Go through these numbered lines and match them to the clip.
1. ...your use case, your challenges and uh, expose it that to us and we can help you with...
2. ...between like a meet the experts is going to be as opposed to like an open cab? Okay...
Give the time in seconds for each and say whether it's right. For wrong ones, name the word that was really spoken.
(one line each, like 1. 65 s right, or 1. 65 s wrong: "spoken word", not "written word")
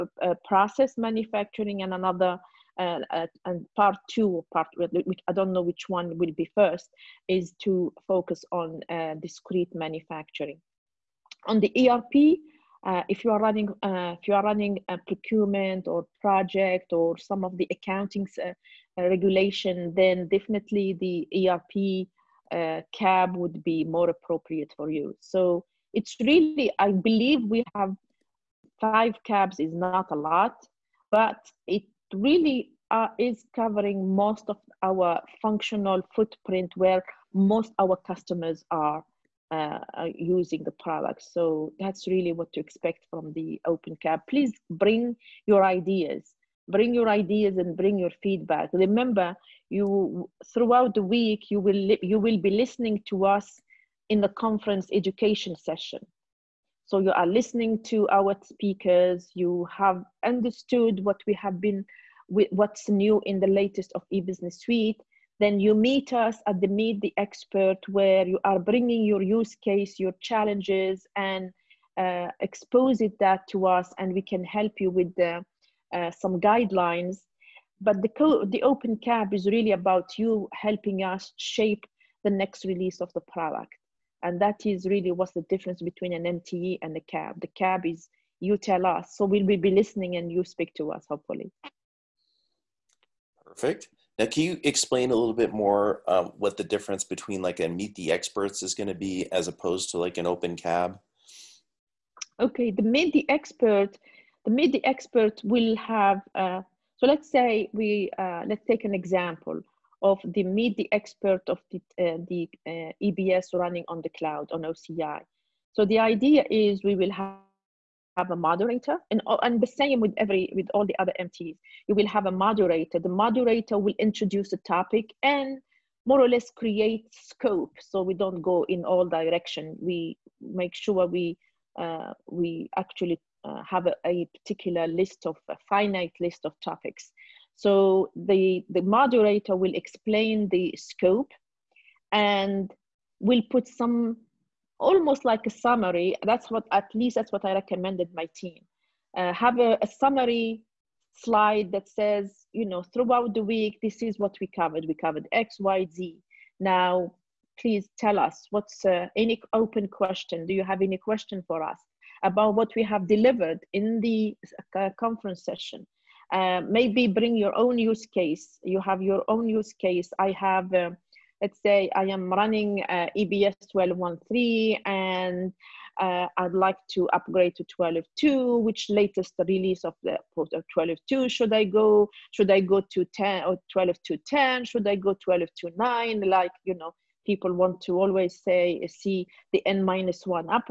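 1. 69 s right
2. 97 s right.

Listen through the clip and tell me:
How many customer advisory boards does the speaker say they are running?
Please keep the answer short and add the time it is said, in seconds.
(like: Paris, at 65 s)
5, at 28 s.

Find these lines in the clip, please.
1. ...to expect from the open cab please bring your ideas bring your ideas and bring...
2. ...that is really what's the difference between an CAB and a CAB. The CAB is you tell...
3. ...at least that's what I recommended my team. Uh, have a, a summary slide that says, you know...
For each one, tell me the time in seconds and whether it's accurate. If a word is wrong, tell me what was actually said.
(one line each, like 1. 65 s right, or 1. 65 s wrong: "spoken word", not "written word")
1. 42 s right
2. 84 s wrong: "MTE", not "CAB"
3. 146 s right.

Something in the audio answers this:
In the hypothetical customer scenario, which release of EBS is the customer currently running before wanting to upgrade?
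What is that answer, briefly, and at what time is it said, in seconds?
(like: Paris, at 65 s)
12.1.3, at 173 s.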